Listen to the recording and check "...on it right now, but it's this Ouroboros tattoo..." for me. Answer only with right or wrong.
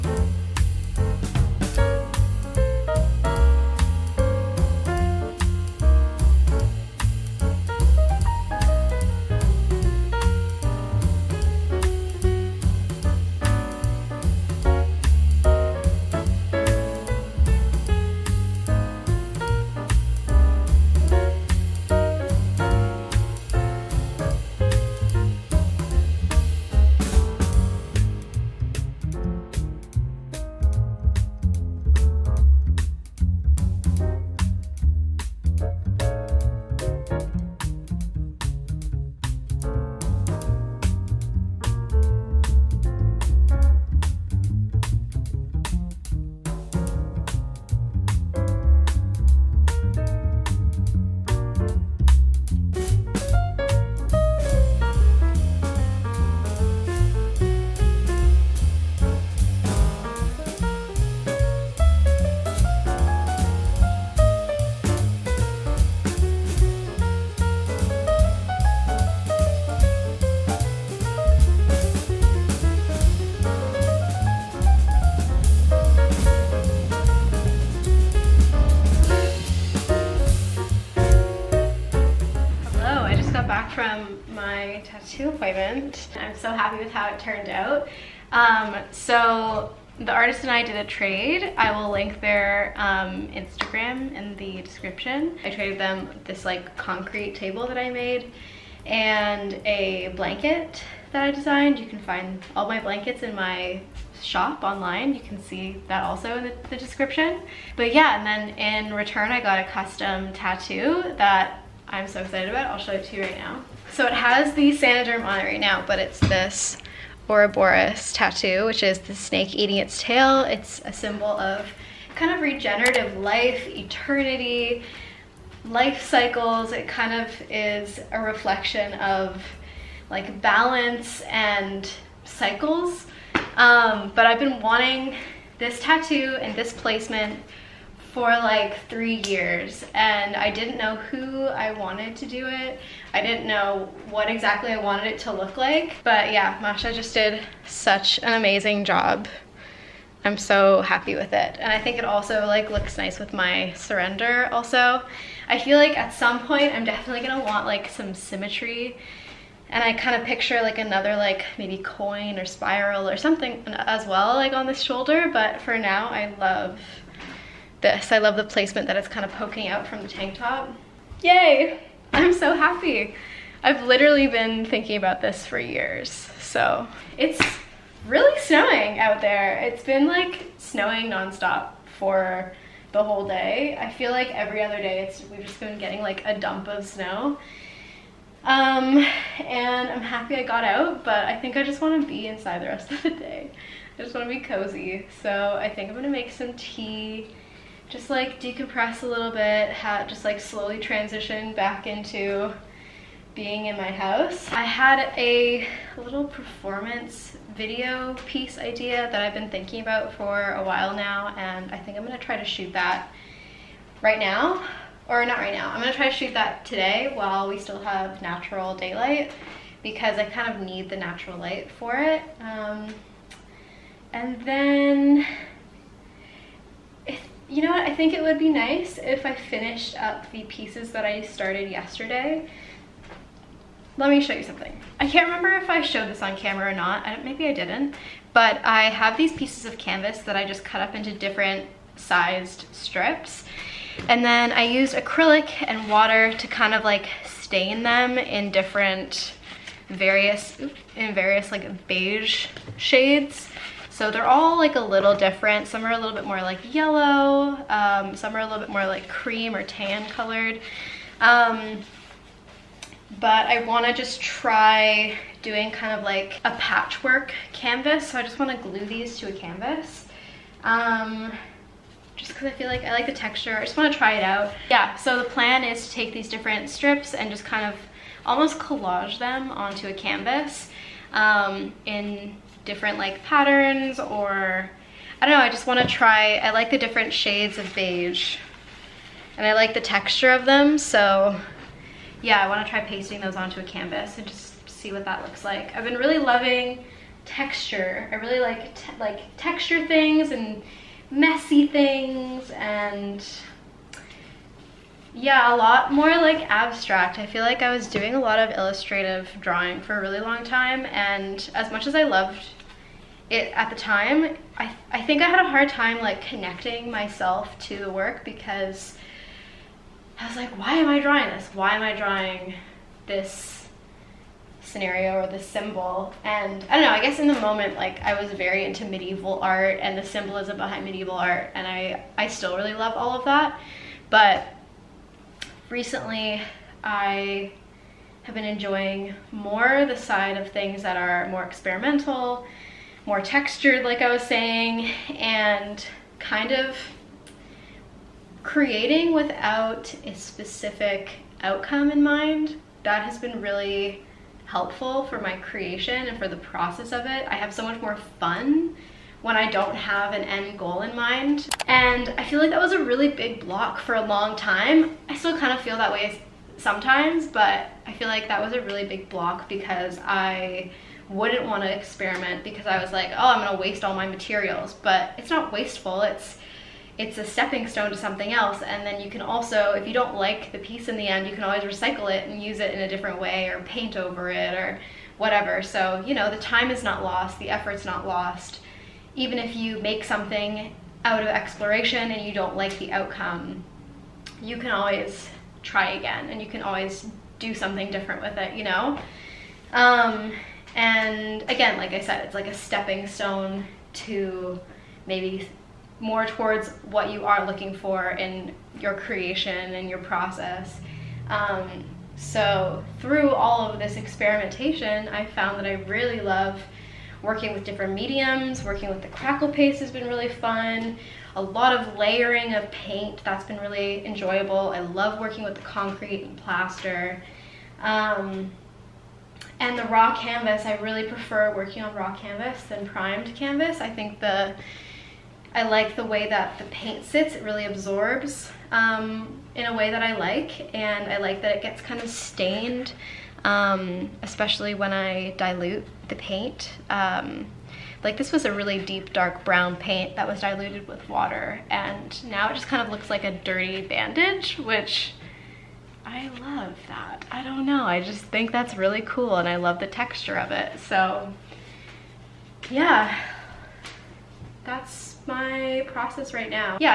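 right.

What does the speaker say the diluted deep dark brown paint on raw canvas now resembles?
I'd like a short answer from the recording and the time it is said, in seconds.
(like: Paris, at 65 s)
a dirty bandage, at 453 s.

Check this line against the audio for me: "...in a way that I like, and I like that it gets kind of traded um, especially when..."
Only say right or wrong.
wrong.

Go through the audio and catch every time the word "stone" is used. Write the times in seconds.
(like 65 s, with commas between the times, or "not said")
377 s, 403 s.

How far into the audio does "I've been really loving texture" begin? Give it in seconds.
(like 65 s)
295 s.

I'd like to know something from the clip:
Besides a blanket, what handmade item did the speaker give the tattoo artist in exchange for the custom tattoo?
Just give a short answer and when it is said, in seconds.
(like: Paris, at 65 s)
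concrete table, at 96 s.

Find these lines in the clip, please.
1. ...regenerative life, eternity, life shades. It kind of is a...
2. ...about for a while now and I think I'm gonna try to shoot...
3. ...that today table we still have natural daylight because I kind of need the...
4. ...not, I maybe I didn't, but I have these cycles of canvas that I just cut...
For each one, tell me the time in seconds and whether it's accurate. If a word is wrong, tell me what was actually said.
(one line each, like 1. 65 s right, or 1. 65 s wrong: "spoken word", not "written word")
1. 122 s wrong: "cycles", not "shades"
2. 209 s right
3. 216 s wrong: "while", not "table"
4. 236 s wrong: "pieces", not "cycles".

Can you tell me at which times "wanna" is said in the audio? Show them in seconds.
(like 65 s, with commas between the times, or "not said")
285 s, 292 s.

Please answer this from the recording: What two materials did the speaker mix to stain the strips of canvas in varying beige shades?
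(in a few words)
acrylic and water.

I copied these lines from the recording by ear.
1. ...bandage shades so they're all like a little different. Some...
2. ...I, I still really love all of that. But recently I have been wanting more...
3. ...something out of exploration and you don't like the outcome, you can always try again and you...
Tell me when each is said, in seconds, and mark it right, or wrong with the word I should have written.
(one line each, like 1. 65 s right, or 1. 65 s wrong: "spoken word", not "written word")
1. 251 s wrong: "beige", not "bandage"
2. 331 s wrong: "enjoying", not "wanting"
3. 390 s right.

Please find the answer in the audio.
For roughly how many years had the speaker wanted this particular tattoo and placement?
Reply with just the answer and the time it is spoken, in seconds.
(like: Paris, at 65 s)
3, at 138 s.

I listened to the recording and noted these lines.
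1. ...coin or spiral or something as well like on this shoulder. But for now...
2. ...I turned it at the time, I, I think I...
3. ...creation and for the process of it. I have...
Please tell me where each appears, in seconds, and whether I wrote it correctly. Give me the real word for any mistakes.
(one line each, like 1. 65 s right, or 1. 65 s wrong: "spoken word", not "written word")
1. 161 s right
2. 311 s wrong: "loved", not "turned"
3. 355 s right.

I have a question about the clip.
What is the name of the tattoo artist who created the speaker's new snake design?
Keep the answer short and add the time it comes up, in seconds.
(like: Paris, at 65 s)
Masha, at 146 s.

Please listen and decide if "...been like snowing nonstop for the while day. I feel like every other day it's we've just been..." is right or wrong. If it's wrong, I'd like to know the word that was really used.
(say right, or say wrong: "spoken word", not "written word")
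wrong: "whole", not "while".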